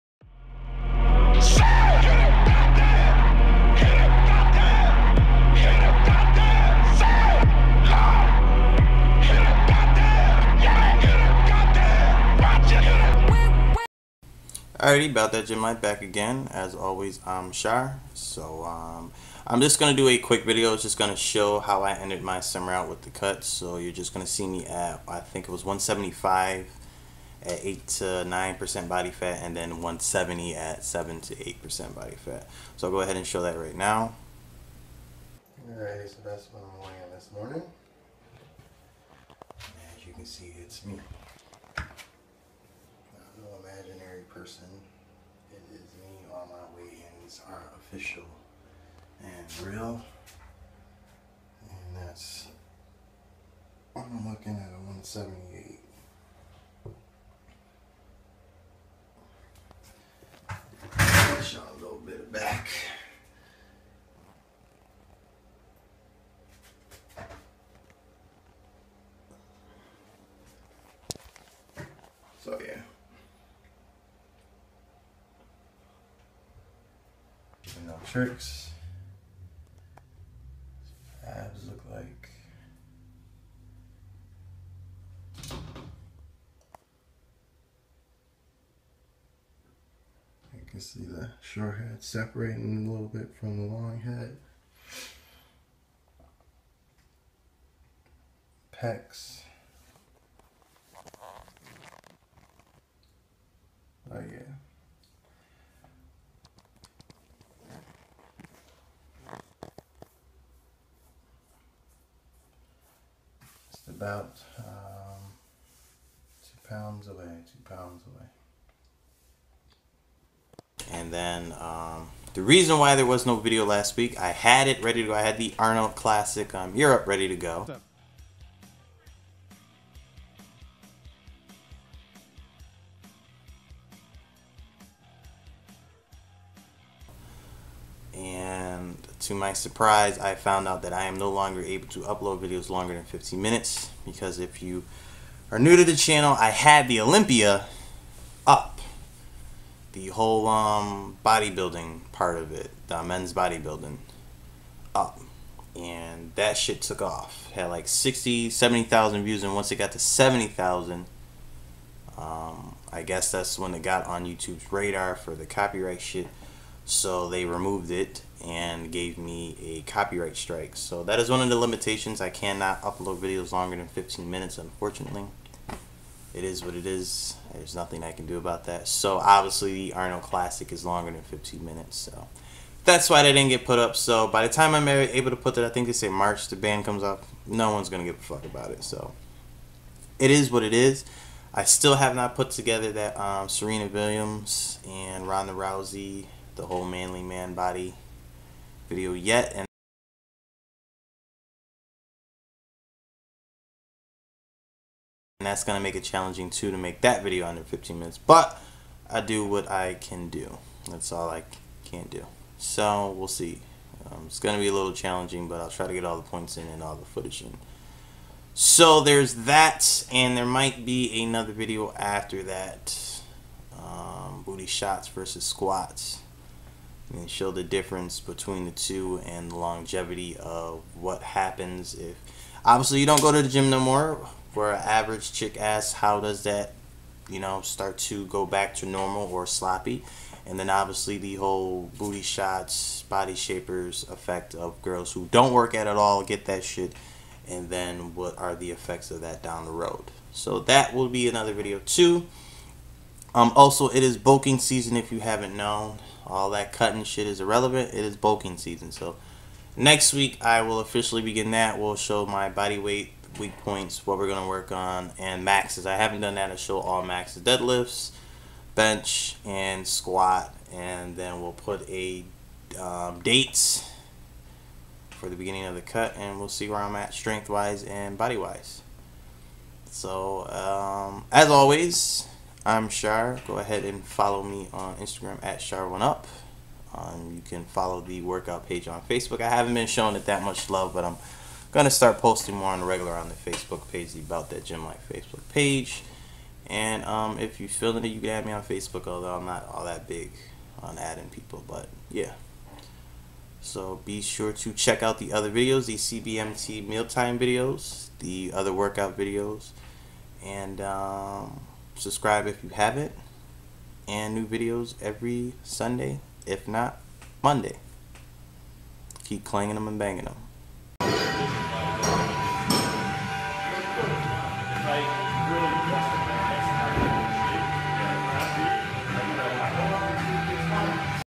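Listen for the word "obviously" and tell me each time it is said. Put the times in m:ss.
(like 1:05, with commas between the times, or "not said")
2:59, 3:52, 4:00.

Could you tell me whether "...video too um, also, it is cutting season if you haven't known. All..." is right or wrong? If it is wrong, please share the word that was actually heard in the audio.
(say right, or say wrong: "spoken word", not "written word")
wrong: "bulking", not "cutting".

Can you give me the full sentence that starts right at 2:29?
The whole um, bodybuilding part of it, the men's bodybuilding up.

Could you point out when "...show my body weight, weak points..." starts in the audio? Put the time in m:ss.
4:21.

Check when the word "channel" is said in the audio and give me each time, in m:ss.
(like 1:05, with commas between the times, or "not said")
2:25.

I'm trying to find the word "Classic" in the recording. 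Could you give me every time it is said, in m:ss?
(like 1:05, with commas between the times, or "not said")
2:05, 3:00.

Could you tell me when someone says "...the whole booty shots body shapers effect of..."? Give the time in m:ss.
4:01.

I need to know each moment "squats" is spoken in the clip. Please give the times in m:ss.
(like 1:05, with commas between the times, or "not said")
3:45, 4:29.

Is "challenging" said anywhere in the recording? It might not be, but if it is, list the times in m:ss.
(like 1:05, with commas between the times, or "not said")
3:26, 3:34.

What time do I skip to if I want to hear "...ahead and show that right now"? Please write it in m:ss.
0:33.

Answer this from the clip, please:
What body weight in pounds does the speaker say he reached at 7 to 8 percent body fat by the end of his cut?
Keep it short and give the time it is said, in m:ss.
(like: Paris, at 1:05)
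170, at 0:29.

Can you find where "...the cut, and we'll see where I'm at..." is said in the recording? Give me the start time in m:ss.
4:35.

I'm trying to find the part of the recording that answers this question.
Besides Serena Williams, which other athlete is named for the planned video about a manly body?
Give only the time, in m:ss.
3:15.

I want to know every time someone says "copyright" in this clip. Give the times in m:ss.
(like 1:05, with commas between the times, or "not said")
2:45, 2:49.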